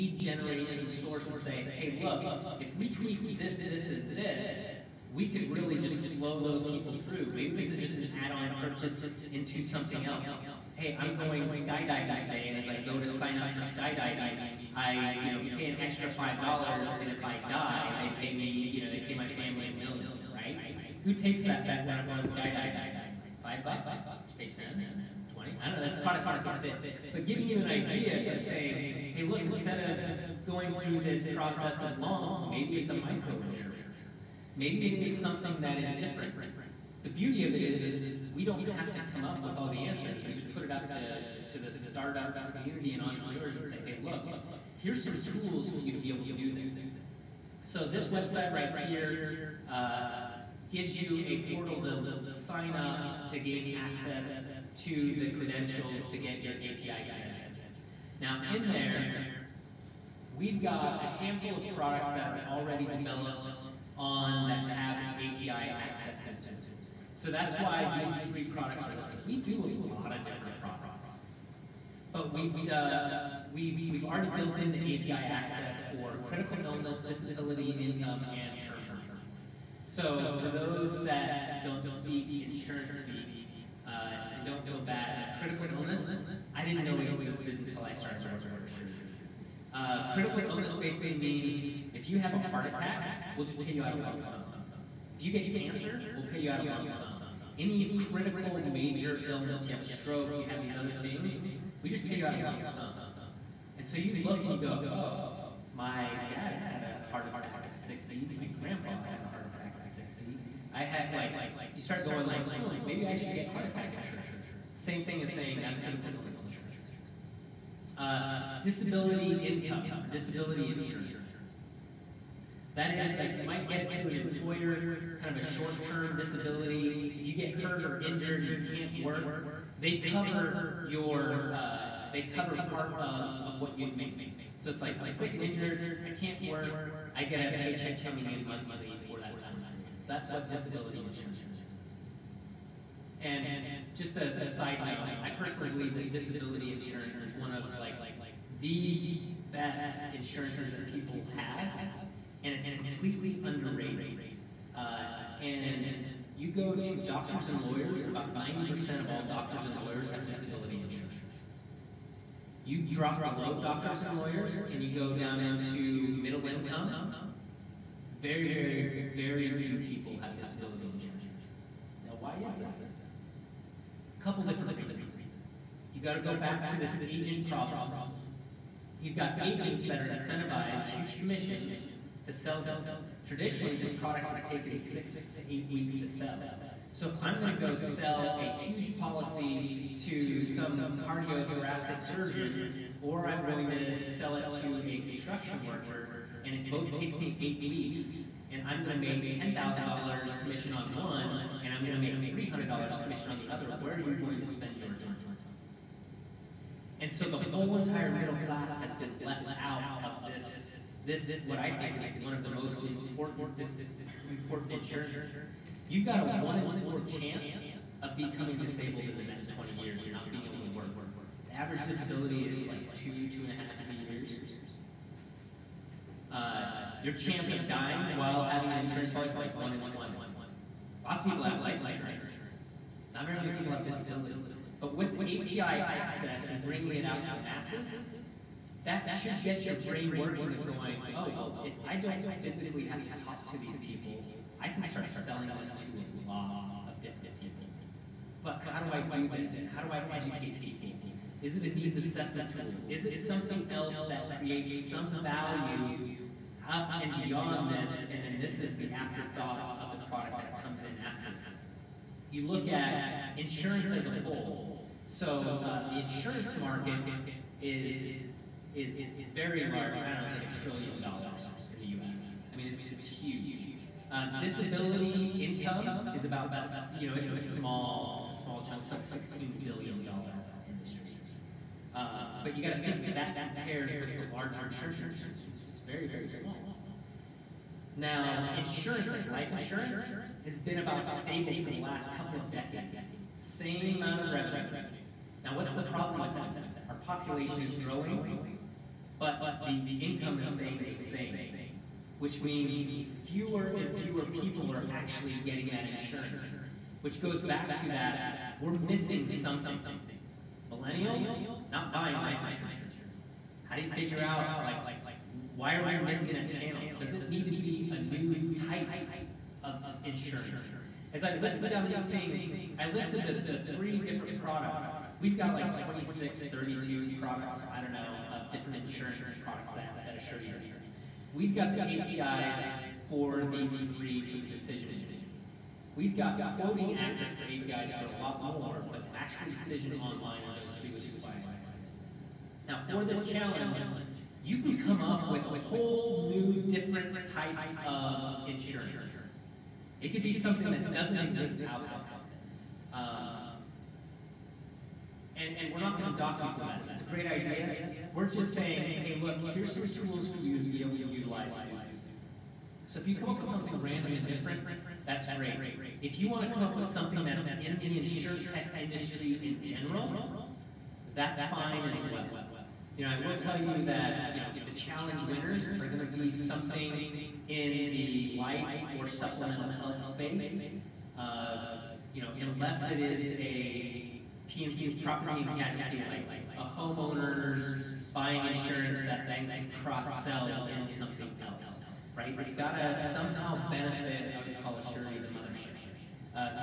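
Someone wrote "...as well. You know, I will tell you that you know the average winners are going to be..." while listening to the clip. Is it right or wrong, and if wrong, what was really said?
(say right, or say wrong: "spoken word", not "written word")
wrong: "challenge", not "average".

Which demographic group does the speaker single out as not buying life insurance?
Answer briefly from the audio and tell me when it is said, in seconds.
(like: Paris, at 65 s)
Millennials, at 310 s.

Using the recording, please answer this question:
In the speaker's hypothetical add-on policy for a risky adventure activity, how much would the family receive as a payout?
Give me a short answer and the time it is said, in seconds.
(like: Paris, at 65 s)
a million, at 19 s.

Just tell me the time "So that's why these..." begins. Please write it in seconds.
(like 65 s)
67 s.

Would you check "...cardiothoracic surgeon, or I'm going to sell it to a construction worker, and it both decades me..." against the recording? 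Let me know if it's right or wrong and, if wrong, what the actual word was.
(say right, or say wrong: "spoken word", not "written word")
wrong: "takes", not "decades".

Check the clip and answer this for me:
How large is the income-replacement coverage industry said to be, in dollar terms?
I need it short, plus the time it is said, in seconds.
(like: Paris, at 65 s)
16 billion dollars, at 279 s.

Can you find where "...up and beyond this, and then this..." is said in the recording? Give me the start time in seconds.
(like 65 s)
256 s.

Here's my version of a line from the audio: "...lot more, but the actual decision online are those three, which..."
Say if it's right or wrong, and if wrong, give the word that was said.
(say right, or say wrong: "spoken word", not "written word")
right.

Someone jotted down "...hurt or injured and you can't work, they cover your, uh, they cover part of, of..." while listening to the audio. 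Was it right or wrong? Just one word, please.
right.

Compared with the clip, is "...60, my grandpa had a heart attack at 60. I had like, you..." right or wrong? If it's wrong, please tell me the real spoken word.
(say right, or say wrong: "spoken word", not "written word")
right.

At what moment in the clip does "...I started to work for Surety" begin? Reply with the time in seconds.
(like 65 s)
87 s.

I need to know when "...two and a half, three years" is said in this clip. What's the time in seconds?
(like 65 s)
223 s.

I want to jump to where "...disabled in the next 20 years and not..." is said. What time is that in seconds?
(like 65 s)
218 s.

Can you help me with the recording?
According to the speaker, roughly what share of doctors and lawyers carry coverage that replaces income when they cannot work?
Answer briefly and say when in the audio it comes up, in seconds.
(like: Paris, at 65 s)
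90%, at 158 s.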